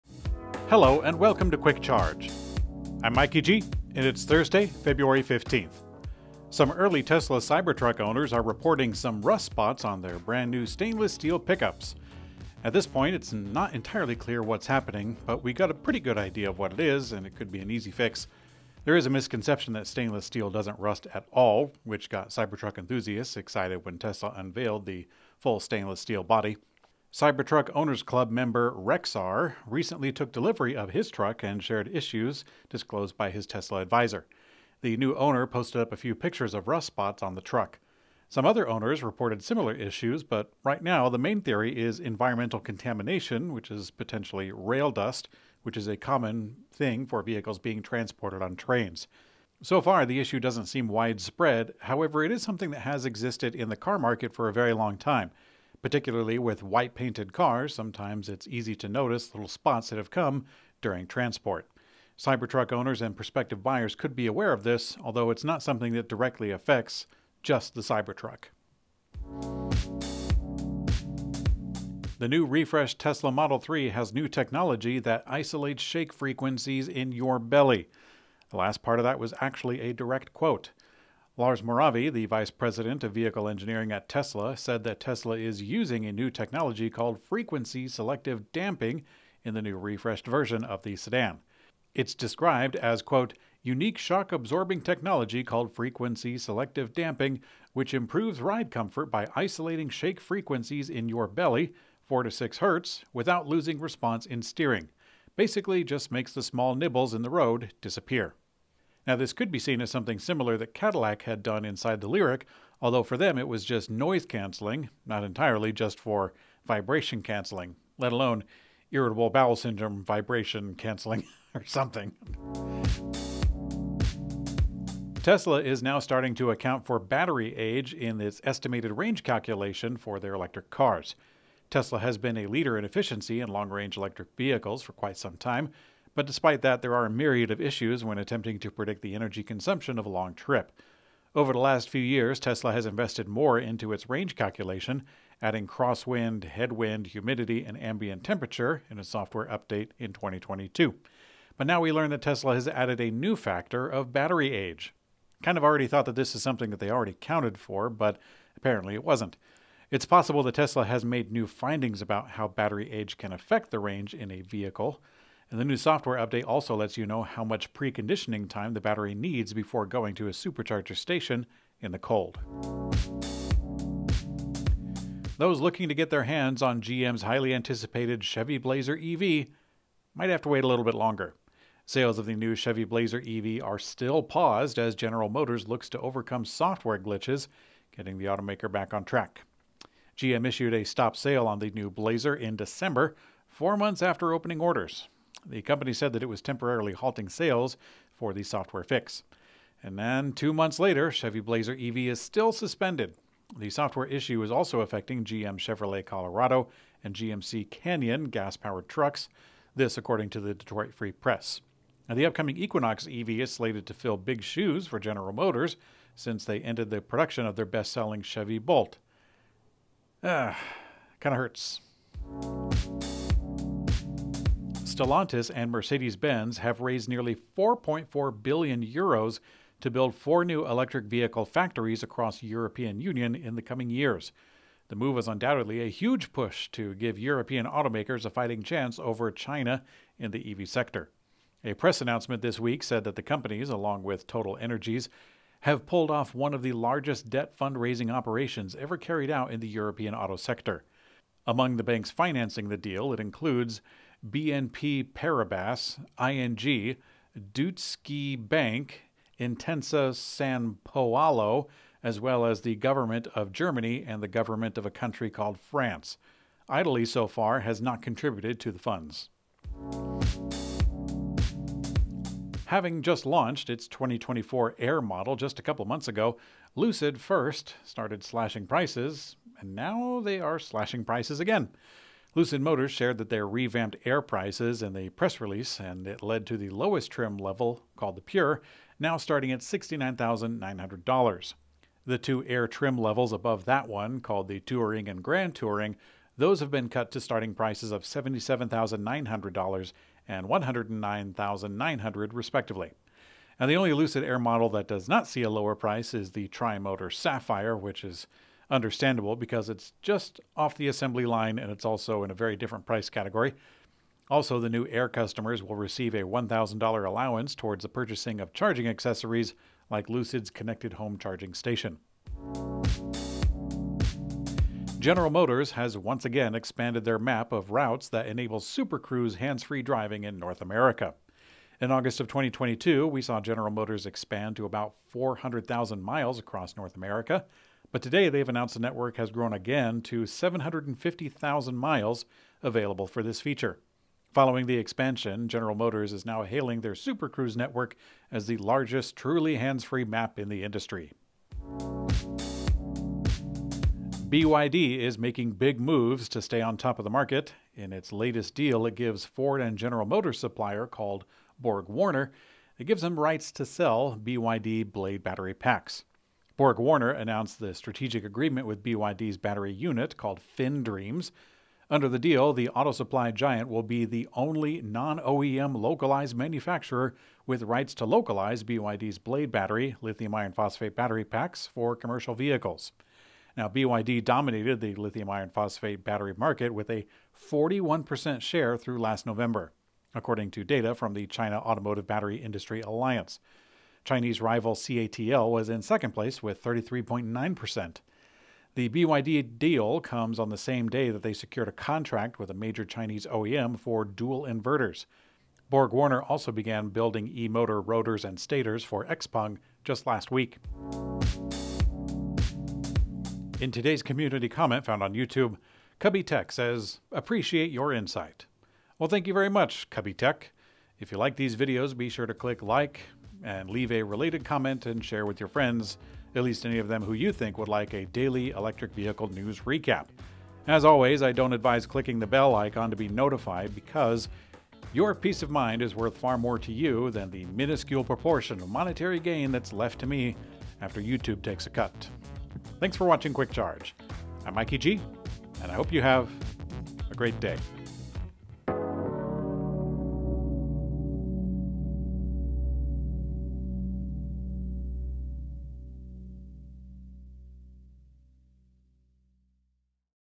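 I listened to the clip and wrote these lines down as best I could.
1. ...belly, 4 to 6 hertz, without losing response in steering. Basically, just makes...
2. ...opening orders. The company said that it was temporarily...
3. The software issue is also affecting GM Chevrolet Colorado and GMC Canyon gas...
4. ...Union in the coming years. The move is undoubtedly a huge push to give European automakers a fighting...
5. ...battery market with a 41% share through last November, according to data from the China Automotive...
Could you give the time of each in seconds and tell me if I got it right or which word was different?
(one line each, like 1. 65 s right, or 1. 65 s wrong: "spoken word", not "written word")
1. 101 s right
2. 194 s right
3. 203 s right
4. 233 s right
5. 386 s right.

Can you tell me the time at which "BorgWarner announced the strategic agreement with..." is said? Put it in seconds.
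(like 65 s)
366 s.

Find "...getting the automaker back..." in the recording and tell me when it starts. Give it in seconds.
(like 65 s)
187 s.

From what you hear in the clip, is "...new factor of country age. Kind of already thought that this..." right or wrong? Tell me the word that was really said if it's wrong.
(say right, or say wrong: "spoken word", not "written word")
wrong: "battery", not "country".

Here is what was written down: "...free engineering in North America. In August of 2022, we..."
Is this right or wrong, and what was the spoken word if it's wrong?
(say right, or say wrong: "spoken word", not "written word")
wrong: "driving", not "engineering".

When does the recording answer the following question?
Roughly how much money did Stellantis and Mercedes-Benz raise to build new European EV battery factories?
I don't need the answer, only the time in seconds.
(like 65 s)
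227 s.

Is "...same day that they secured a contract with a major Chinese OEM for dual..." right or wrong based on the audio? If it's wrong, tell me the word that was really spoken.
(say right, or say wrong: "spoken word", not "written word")
right.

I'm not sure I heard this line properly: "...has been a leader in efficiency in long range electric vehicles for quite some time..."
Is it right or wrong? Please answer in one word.
right.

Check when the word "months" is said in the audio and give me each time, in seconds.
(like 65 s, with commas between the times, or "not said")
193 s, 200 s, 275 s.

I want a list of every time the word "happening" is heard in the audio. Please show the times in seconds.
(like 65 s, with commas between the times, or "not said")
14 s.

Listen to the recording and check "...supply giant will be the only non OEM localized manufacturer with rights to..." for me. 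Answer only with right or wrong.
right.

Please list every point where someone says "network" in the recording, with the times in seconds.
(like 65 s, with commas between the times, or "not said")
338 s, 347 s.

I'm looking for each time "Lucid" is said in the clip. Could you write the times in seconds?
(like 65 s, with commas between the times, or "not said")
276 s, 282 s, 303 s, 320 s.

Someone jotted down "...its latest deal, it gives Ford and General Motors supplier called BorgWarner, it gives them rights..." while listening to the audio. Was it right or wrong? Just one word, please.
right.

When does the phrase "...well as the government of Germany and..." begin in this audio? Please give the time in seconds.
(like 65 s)
262 s.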